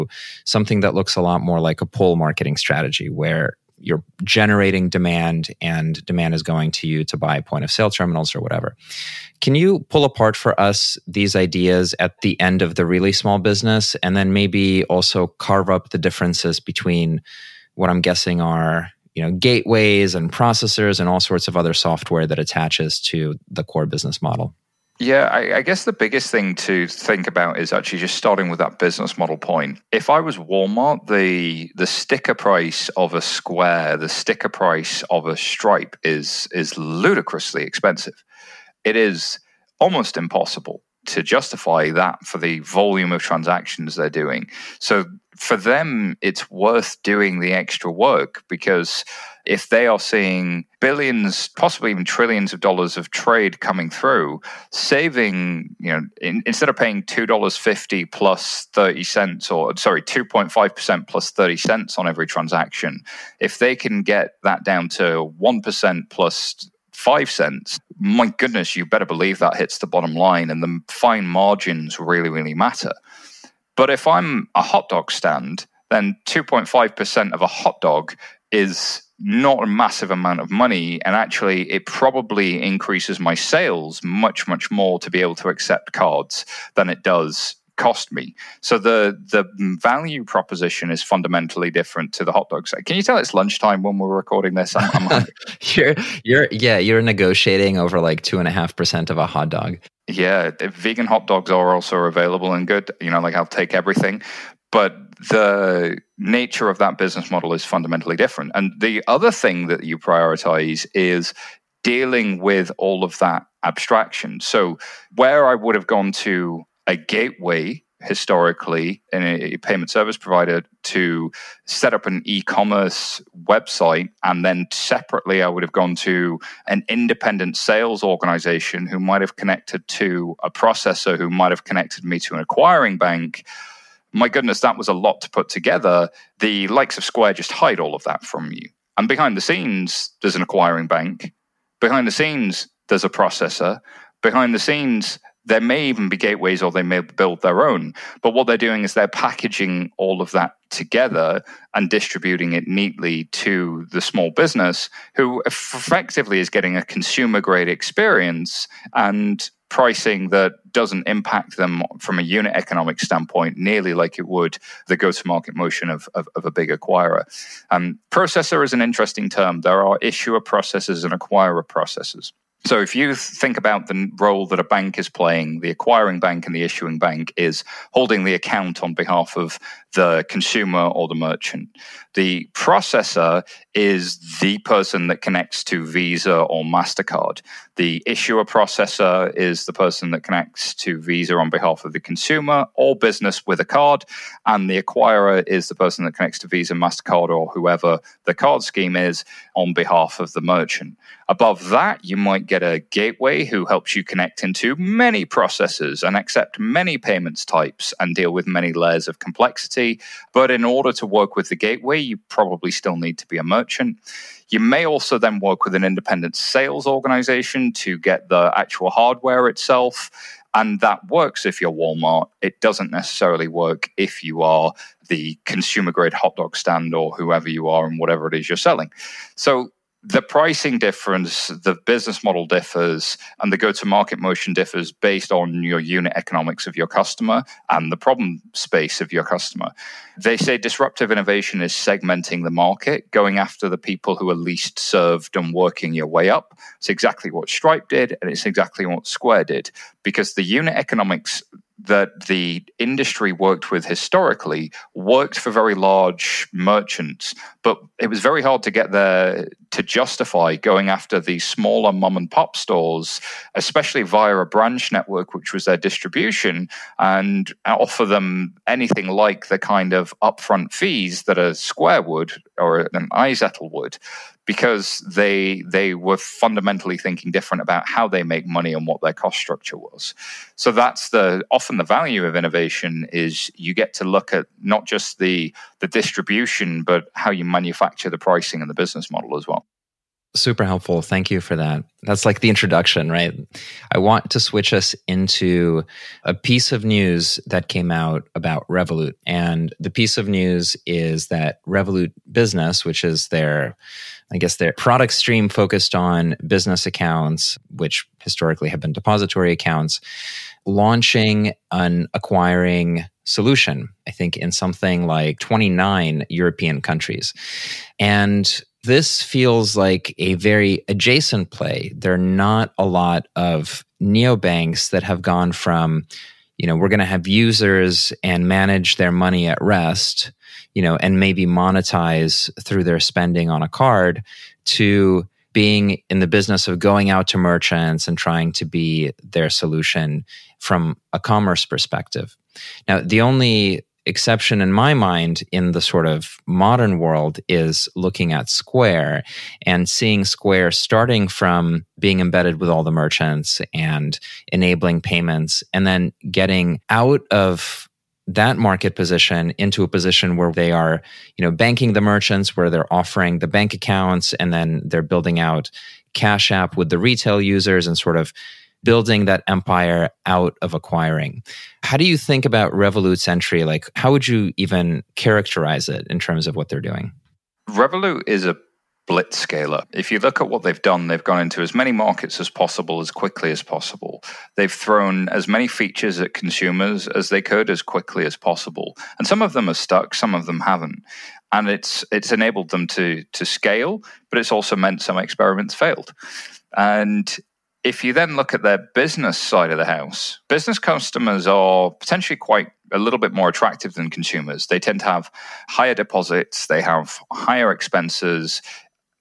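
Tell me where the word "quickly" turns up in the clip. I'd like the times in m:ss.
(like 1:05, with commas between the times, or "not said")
6:23, 6:27.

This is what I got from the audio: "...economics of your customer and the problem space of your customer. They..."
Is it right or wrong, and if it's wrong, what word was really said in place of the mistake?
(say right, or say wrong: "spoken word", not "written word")
right.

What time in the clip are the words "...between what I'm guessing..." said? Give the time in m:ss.
0:16.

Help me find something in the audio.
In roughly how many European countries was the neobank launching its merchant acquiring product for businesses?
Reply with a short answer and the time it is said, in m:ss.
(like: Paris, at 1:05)
29, at 5:15.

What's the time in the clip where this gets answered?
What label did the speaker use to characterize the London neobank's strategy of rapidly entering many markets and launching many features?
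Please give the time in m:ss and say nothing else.
6:19.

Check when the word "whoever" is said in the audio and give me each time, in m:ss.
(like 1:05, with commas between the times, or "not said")
3:17, 3:47.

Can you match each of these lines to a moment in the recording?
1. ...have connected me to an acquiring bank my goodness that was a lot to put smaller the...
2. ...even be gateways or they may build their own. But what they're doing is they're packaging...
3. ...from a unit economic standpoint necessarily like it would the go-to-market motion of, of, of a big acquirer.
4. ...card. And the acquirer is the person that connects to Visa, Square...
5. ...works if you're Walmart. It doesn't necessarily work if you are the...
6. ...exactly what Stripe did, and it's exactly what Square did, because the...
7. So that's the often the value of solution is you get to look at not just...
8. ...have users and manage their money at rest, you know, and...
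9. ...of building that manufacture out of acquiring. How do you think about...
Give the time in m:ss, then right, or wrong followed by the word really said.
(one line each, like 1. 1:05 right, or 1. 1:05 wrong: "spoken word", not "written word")
1. 2:11 wrong: "together", not "smaller"
2. 2:25 right
3. 2:41 wrong: "nearly", not "necessarily"
4. 3:13 wrong: "MasterCard", not "Square"
5. 3:41 right
6. 4:06 right
7. 4:40 wrong: "innovation", not "solution"
8. 5:27 right
9. 6:08 wrong: "empire", not "manufacture".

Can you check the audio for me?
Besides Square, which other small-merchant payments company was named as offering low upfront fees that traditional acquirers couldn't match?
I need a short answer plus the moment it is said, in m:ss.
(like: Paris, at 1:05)
iZettle, at 4:33.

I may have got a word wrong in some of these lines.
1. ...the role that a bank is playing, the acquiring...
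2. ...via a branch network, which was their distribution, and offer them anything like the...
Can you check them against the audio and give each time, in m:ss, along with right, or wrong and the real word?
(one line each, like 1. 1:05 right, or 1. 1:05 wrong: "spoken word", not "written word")
1. 2:53 right
2. 4:24 right.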